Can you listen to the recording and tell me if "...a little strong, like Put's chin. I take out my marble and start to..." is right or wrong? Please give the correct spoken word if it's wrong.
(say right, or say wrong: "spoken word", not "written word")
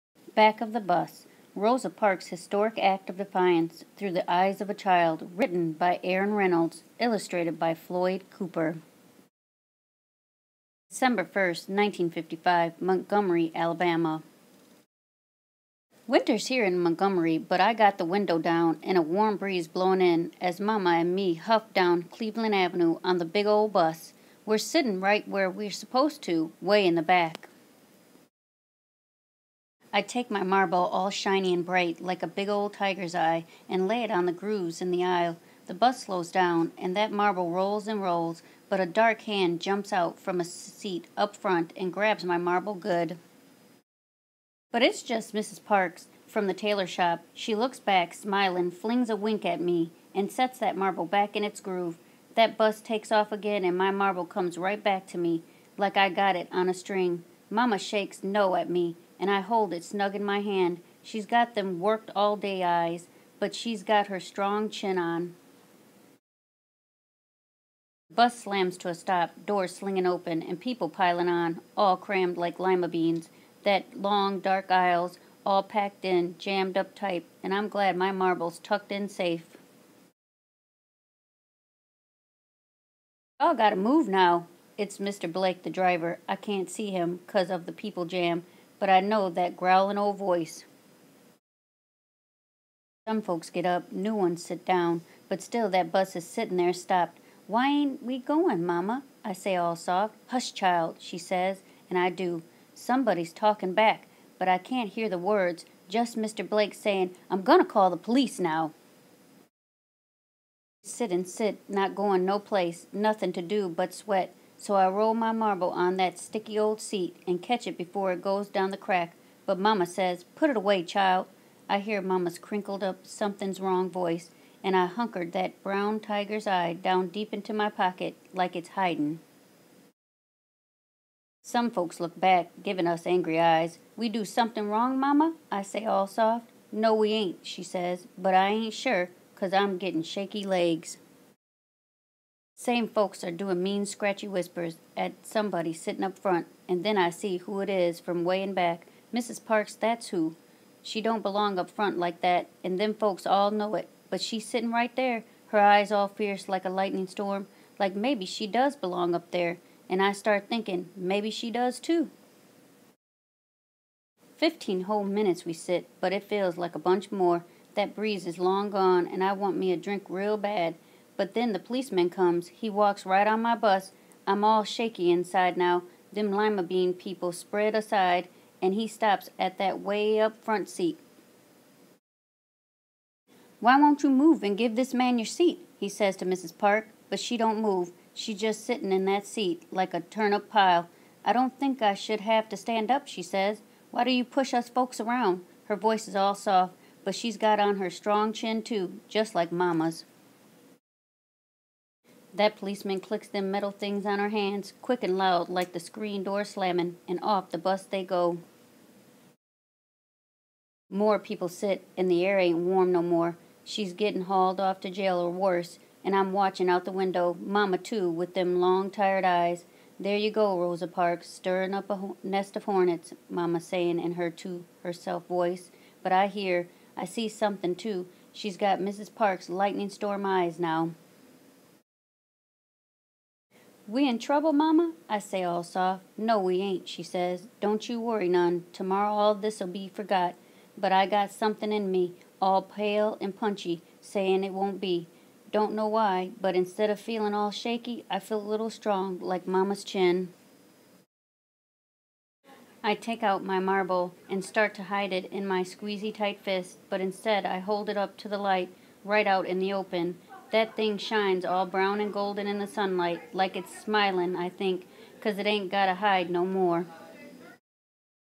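wrong: "Mama", not "Put".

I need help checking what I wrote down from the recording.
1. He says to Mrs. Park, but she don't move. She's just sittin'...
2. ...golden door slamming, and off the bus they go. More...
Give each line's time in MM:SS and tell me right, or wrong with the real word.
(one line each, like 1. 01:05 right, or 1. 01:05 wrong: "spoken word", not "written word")
1. 03:05 right
2. 03:25 wrong: "screen", not "golden".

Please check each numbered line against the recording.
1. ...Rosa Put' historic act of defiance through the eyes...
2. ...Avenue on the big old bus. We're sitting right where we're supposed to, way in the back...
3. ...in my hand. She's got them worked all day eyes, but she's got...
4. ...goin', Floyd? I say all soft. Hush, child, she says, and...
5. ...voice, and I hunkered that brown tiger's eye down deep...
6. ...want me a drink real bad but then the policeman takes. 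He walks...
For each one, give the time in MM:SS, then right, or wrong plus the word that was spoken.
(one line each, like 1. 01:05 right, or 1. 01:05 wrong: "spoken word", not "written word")
1. 00:01 wrong: "Parks", not "Put"
2. 00:22 right
3. 01:00 right
4. 01:38 wrong: "Mama", not "Floyd"
5. 02:03 right
6. 02:49 wrong: "comes", not "takes".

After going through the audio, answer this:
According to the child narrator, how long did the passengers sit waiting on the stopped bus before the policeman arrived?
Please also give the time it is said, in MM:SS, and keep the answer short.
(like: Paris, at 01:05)
15 minutes, at 02:44.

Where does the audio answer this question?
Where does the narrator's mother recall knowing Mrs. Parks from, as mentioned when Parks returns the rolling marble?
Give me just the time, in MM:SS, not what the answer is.
00:46.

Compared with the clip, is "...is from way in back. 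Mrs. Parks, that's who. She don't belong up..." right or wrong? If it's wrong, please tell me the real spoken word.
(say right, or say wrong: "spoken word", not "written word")
right.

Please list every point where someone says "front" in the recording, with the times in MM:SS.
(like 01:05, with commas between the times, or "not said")
00:41, 02:26, 02:31, 03:00.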